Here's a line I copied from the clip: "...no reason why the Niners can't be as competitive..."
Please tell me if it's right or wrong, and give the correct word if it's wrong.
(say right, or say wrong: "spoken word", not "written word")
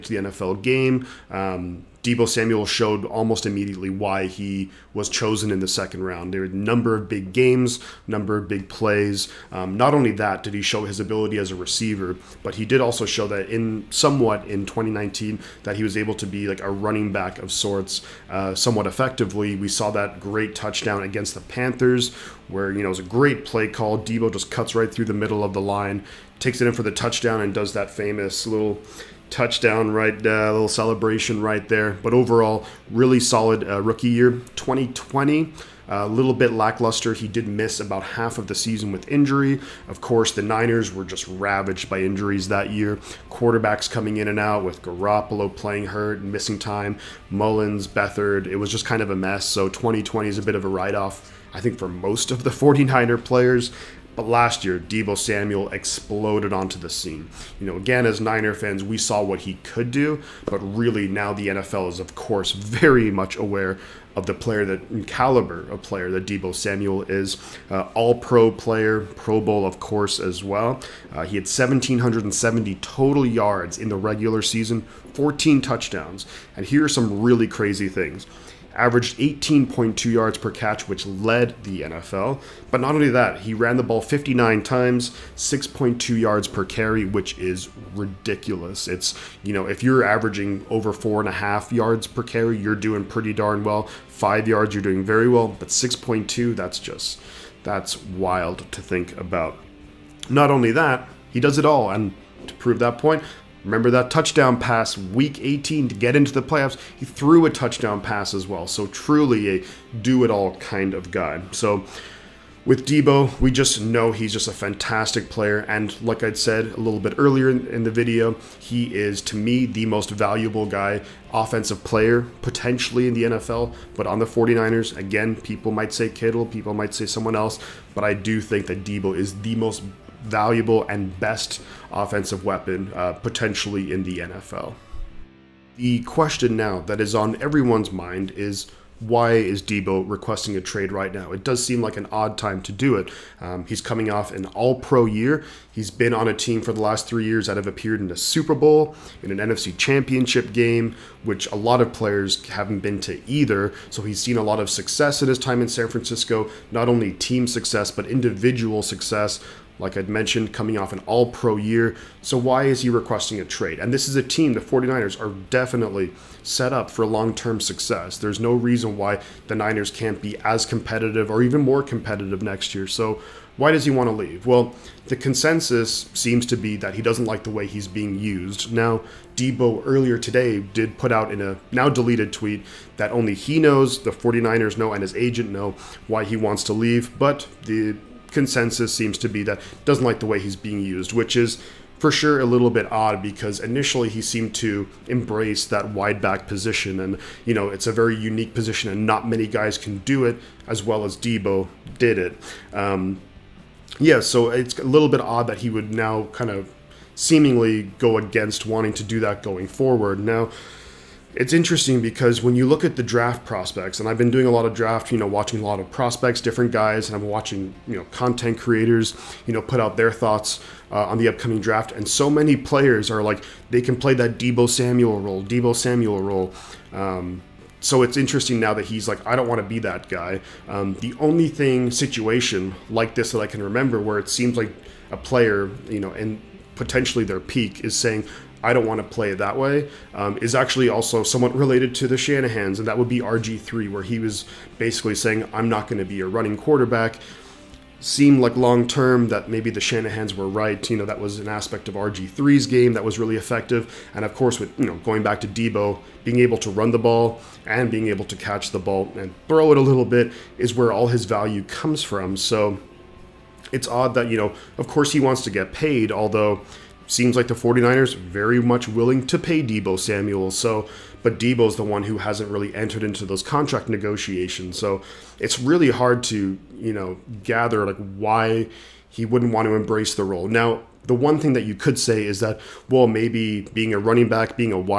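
right.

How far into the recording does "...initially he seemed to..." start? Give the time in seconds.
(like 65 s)
193 s.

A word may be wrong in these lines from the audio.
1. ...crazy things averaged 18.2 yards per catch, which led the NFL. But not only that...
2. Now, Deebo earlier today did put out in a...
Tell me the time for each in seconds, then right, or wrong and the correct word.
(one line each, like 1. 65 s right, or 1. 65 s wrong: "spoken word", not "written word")
1. 77 s right
2. 178 s right.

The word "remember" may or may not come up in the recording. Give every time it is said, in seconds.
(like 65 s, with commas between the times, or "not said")
103 s, 233 s.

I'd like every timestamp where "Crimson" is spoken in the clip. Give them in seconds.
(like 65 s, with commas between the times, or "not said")
not said.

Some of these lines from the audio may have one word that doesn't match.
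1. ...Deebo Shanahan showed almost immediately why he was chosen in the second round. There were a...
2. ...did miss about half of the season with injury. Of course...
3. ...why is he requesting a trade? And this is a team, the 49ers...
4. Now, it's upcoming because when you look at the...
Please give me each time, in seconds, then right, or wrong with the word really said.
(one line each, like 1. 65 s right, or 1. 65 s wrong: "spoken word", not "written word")
1. 2 s wrong: "Samuel", not "Shanahan"
2. 37 s right
3. 162 s right
4. 210 s wrong: "interesting", not "upcoming".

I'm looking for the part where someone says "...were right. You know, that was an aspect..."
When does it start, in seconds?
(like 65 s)
250 s.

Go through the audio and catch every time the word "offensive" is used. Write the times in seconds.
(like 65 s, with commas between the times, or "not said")
121 s, 131 s.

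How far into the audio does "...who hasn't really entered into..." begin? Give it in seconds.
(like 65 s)
272 s.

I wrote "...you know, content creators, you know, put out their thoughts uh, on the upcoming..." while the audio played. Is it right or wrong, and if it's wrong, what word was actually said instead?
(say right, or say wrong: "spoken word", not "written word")
right.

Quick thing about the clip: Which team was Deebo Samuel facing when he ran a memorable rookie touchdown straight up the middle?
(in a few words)
Panthers.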